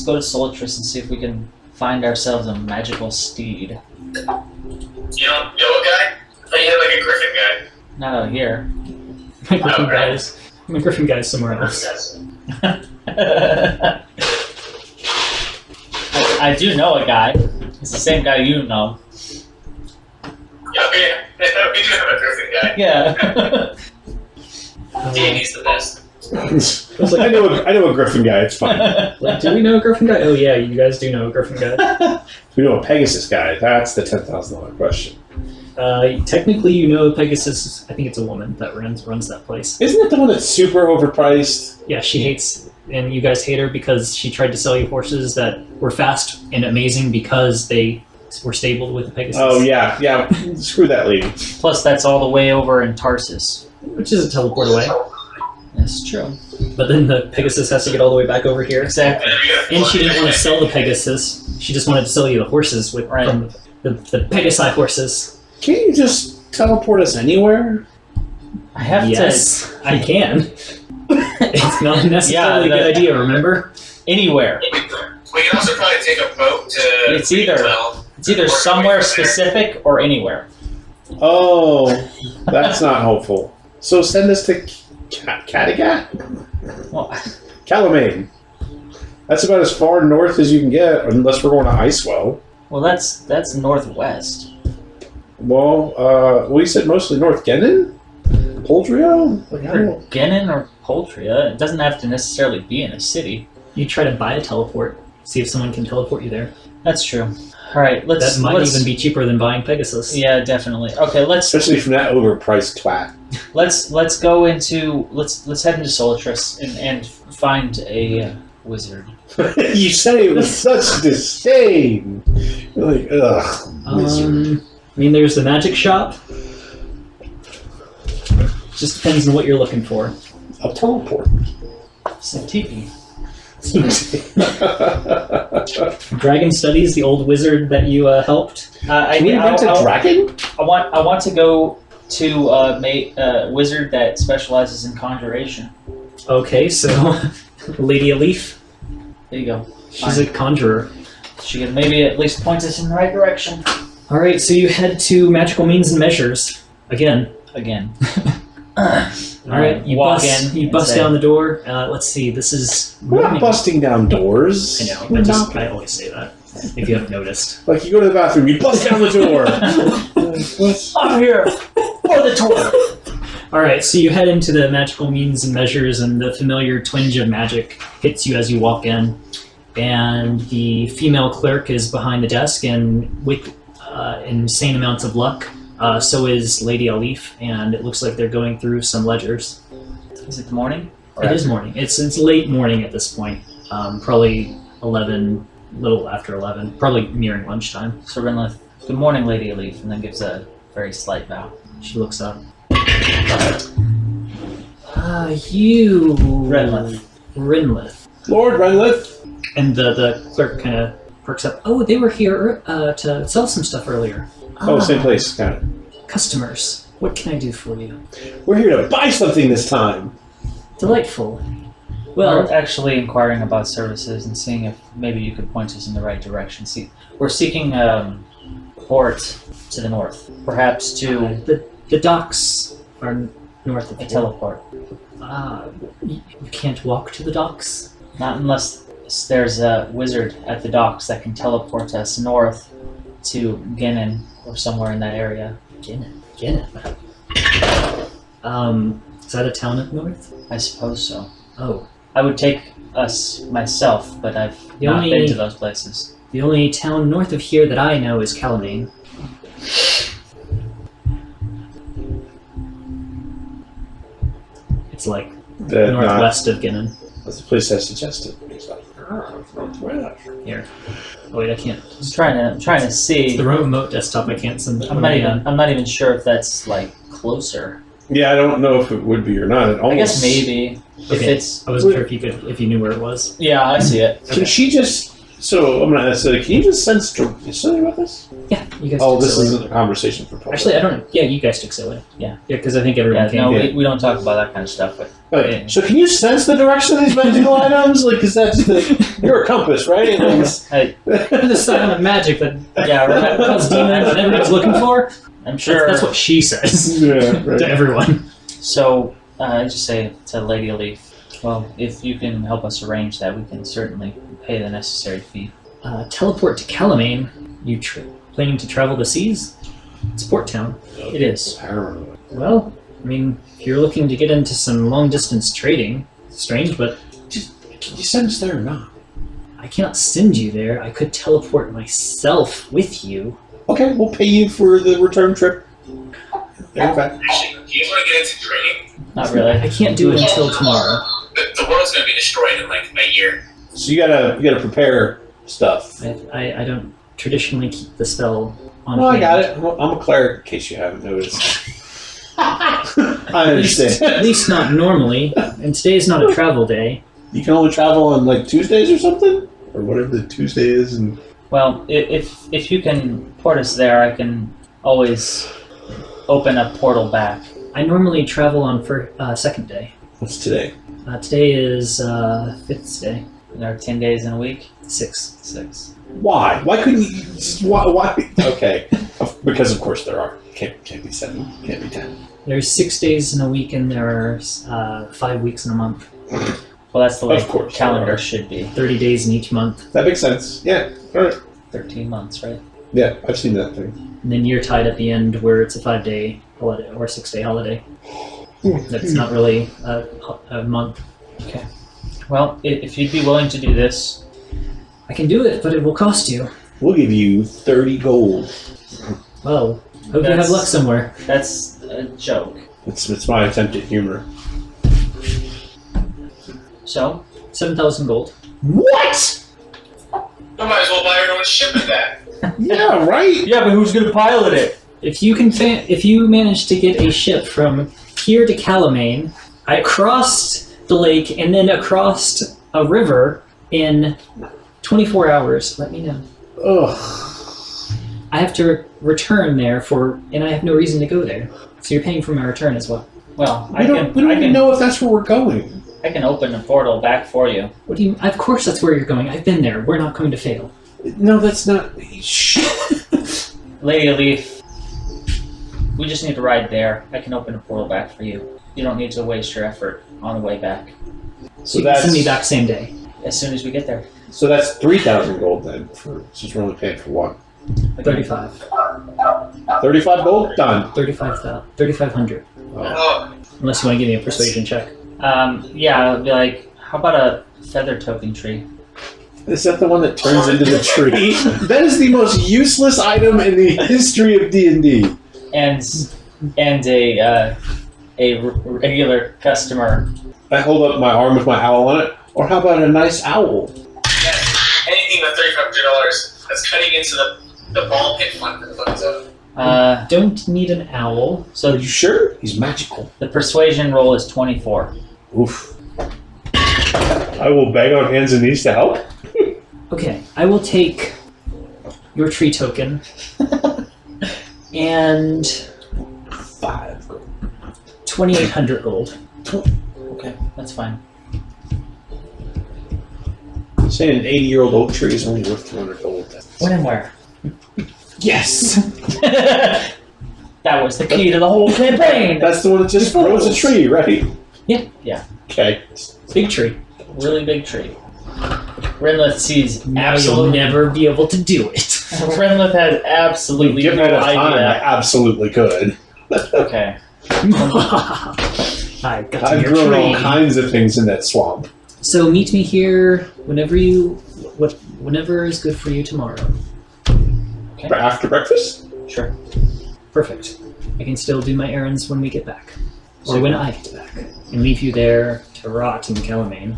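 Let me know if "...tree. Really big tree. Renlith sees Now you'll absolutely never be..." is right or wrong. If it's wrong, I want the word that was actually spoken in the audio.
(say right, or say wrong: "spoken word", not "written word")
right.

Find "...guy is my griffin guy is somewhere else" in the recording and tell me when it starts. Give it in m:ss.
0:09.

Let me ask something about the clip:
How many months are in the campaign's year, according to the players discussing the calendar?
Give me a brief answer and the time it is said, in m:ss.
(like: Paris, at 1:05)
13, at 6:31.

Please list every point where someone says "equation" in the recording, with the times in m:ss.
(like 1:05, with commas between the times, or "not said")
not said.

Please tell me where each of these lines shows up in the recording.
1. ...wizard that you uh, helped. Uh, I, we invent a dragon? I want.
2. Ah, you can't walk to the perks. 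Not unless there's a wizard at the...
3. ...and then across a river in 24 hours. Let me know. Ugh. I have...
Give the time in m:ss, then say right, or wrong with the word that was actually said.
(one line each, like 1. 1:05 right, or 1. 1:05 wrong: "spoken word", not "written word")
1. 2:17 right
2. 3:55 wrong: "docks", not "perks"
3. 7:11 right.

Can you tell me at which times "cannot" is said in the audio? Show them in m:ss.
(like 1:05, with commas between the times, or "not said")
5:29.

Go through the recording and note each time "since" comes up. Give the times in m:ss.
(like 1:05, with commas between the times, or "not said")
7:46.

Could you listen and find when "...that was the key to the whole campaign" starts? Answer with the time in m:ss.
8:49.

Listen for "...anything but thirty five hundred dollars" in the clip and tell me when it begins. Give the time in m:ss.
8:14.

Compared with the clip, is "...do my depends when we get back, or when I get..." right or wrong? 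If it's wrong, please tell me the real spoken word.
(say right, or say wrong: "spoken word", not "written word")
wrong: "errands", not "depends".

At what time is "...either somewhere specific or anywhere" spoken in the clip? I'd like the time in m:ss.
1:18.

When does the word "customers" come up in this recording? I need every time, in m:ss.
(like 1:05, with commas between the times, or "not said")
3:36, 8:09.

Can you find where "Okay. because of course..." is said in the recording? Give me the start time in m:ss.
6:18.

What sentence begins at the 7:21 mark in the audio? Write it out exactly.
So you're paying for my return as well.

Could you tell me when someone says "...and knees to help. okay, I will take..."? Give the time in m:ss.
8:28.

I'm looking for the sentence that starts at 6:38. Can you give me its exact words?
That's not really a, a month.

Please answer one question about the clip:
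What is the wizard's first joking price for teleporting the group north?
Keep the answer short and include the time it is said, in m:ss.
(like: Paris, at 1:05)
7,000 gold, at 6:57.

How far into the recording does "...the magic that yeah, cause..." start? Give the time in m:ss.
5:01.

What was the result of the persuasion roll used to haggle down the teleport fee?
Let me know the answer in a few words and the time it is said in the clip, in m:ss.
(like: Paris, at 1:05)
24, at 8:24.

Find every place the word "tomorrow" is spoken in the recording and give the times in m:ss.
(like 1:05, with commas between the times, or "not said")
5:40, 9:16.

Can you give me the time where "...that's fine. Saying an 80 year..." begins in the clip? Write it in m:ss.
8:40.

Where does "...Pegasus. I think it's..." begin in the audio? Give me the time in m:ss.
0:37.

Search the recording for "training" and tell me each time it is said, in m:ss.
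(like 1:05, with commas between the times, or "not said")
5:38.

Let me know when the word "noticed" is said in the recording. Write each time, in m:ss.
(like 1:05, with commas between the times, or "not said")
2:47, 5:51.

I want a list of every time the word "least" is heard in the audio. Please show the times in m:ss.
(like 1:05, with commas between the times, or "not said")
2:32, 5:54.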